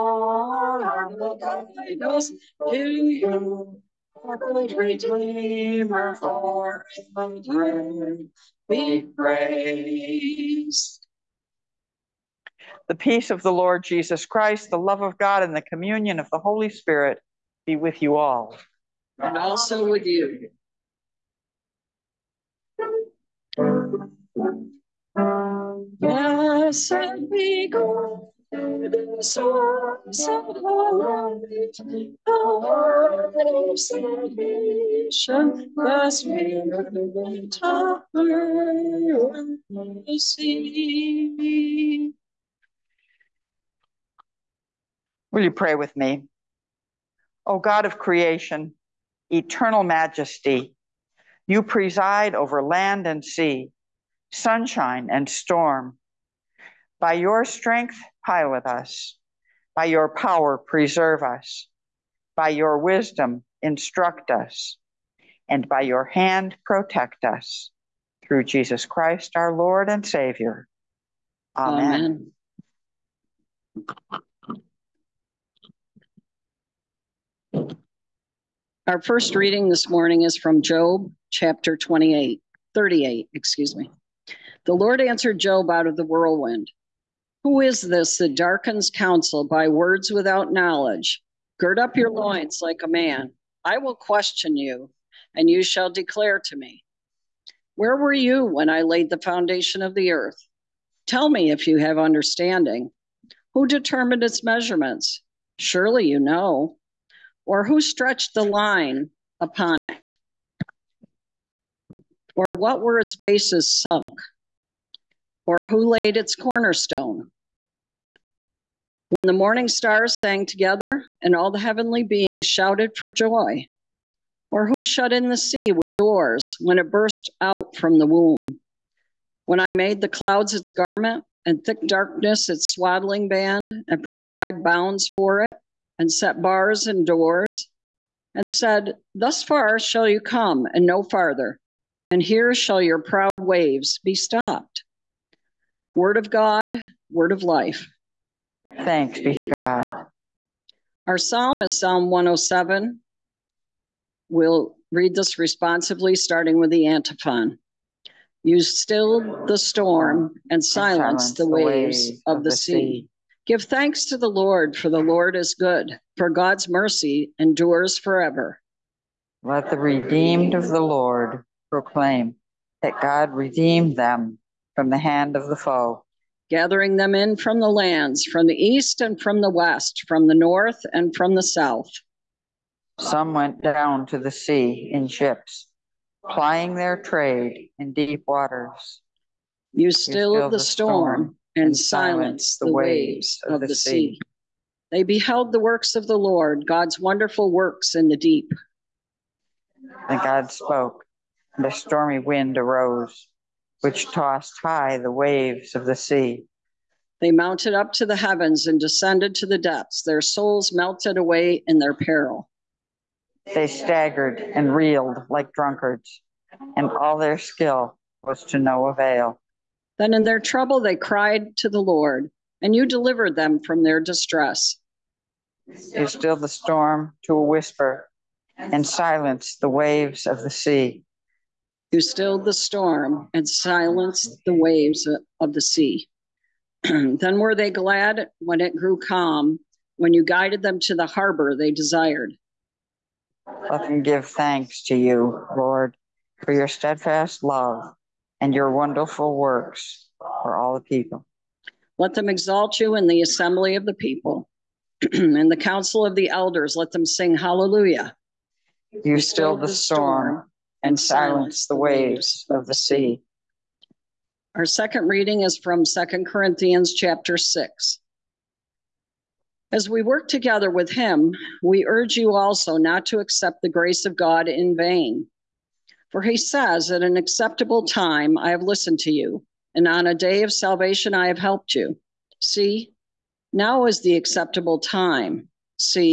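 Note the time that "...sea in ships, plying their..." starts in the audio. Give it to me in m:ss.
3:04.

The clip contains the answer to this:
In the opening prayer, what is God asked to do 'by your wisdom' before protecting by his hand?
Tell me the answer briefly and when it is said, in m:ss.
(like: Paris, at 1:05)
instruct us, at 1:03.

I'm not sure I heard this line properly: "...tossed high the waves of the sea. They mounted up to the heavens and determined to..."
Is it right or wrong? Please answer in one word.
wrong.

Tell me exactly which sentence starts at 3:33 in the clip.
They staggered and reeled like drunkards, and all their skill was to no avail.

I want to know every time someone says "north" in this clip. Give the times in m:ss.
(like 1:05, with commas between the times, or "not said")
3:00.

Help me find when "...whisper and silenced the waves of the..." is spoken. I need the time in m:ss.
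3:47.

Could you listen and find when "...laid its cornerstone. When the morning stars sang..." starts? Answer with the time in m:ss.
1:55.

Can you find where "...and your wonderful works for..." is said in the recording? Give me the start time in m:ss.
4:08.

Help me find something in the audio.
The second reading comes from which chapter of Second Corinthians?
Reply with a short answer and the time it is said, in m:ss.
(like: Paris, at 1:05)
6, at 4:26.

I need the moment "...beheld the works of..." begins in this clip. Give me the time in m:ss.
3:15.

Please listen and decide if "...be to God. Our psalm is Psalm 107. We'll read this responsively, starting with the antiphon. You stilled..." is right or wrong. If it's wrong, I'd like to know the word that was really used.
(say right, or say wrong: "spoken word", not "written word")
right.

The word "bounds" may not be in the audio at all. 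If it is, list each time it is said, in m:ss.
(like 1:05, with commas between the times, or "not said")
2:14.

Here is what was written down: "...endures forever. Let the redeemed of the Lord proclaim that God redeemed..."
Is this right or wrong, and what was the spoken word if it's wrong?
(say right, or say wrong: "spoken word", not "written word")
right.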